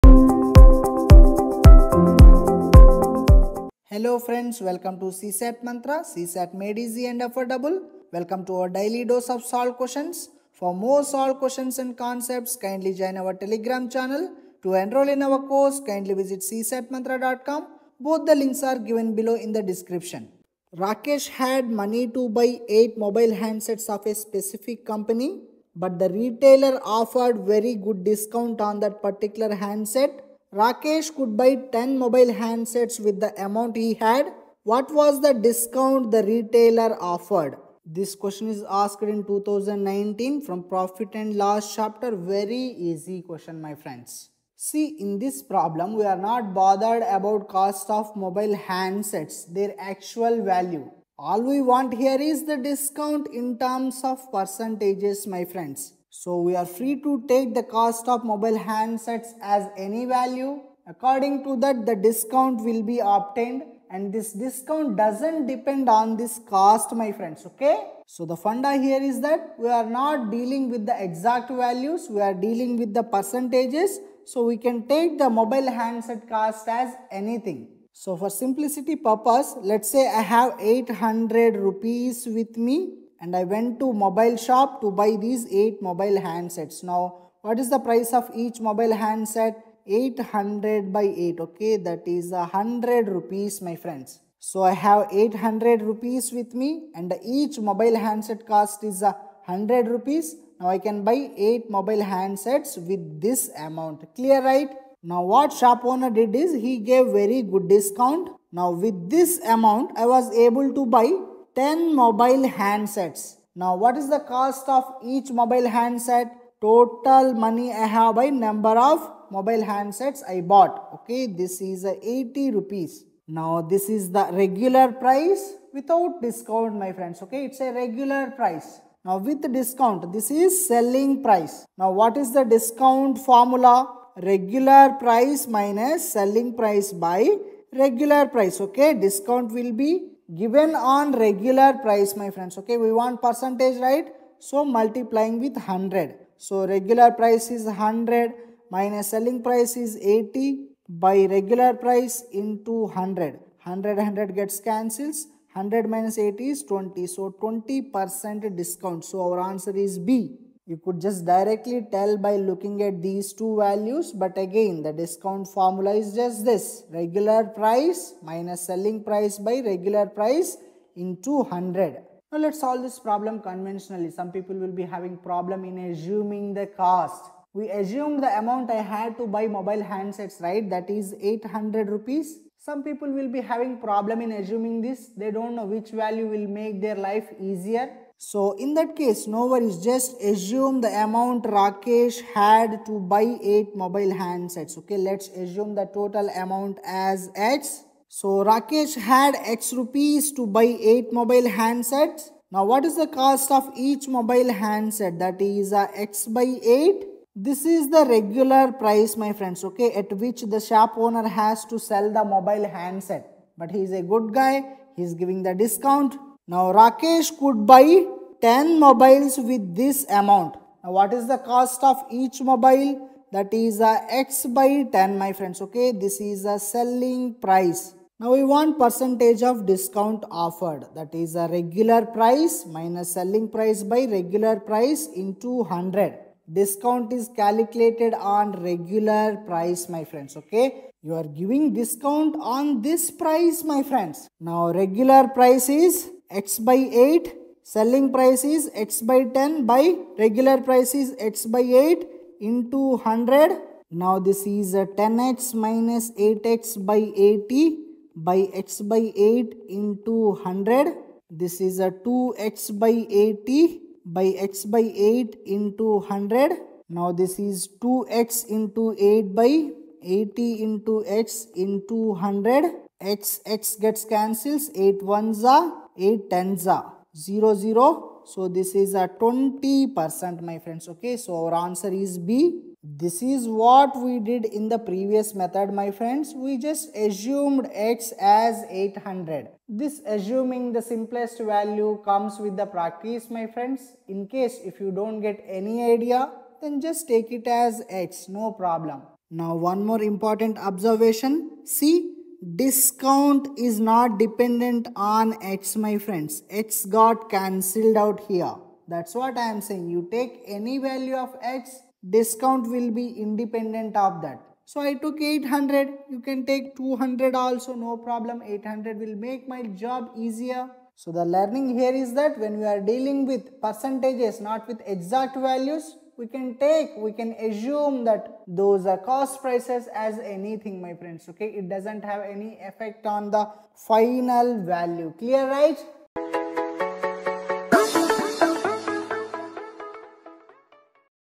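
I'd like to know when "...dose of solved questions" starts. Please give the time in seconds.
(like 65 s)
9 s.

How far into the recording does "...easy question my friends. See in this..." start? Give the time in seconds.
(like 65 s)
42 s.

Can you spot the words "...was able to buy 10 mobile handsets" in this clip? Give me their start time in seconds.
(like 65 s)
110 s.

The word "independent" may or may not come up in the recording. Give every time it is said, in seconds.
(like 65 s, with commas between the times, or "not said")
313 s.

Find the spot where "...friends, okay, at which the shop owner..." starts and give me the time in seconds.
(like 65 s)
209 s.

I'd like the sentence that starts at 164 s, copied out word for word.
But again, the discount formula is just this.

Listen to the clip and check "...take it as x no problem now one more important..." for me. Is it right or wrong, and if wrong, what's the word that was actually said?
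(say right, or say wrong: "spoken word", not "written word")
right.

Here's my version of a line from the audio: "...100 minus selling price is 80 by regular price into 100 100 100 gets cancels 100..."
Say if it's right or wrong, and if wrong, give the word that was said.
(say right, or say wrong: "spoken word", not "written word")
right.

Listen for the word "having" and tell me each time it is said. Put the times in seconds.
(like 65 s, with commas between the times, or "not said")
174 s, 183 s.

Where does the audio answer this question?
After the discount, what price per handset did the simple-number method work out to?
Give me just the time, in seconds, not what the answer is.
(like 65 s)
121 s.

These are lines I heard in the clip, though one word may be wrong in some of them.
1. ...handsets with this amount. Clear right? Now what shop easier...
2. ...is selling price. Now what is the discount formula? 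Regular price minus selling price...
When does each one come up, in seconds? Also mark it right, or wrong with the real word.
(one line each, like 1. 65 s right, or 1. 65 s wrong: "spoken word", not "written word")
1. 102 s wrong: "owner", not "easier"
2. 130 s right.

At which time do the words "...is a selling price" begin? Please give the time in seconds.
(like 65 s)
226 s.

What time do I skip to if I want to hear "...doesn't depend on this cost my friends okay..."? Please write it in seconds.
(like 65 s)
64 s.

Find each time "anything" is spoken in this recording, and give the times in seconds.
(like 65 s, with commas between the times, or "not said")
77 s, 330 s.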